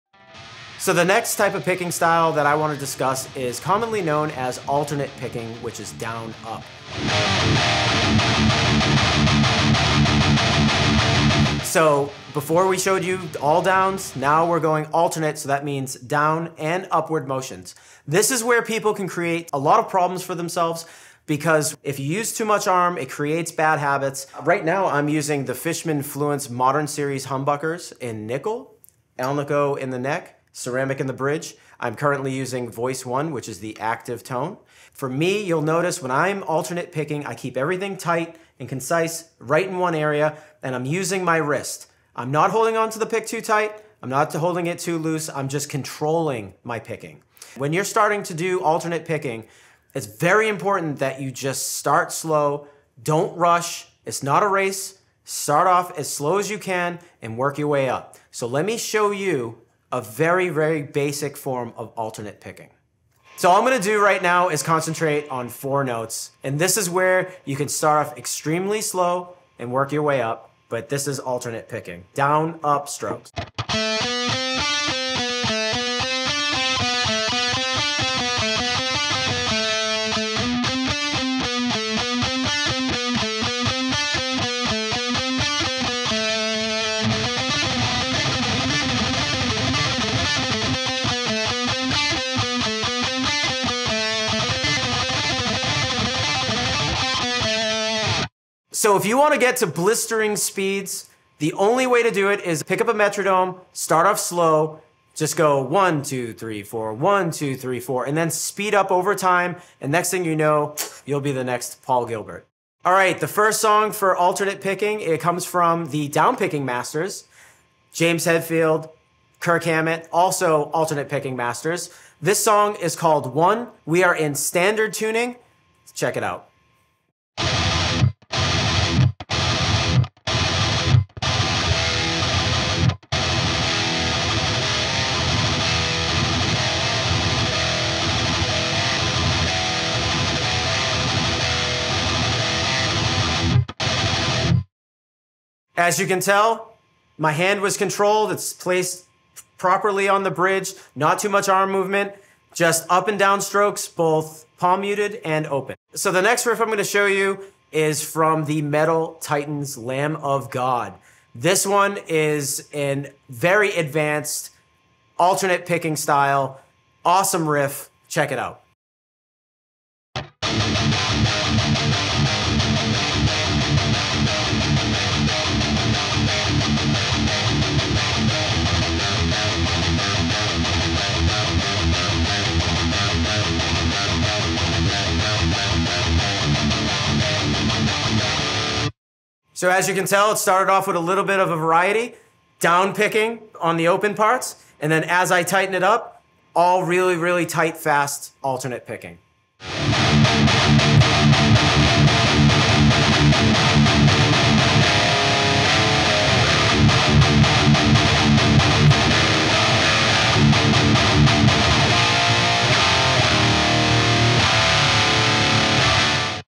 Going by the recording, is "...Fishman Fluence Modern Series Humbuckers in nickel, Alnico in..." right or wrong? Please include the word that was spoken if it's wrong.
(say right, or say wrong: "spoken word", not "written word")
right.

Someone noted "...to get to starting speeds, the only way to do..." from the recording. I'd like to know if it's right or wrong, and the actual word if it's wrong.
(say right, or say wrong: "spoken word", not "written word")
wrong: "blistering", not "starting".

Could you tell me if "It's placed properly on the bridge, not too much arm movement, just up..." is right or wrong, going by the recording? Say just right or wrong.
right.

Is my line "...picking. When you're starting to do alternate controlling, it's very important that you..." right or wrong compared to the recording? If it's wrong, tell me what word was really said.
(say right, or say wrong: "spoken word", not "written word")
wrong: "picking", not "controlling".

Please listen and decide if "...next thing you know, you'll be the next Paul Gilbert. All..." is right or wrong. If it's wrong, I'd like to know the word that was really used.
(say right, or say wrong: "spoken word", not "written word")
right.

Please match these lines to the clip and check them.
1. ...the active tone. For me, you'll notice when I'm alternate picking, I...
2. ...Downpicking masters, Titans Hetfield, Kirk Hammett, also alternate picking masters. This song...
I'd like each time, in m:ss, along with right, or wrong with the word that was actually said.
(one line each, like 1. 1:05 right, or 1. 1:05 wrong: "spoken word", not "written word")
1. 0:33 right
2. 1:56 wrong: "James", not "Titans".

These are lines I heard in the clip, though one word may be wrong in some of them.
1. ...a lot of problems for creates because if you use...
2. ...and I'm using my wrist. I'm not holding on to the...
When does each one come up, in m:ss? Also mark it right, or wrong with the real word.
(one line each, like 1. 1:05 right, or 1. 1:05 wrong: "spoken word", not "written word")
1. 0:19 wrong: "themselves", not "creates"
2. 0:40 right.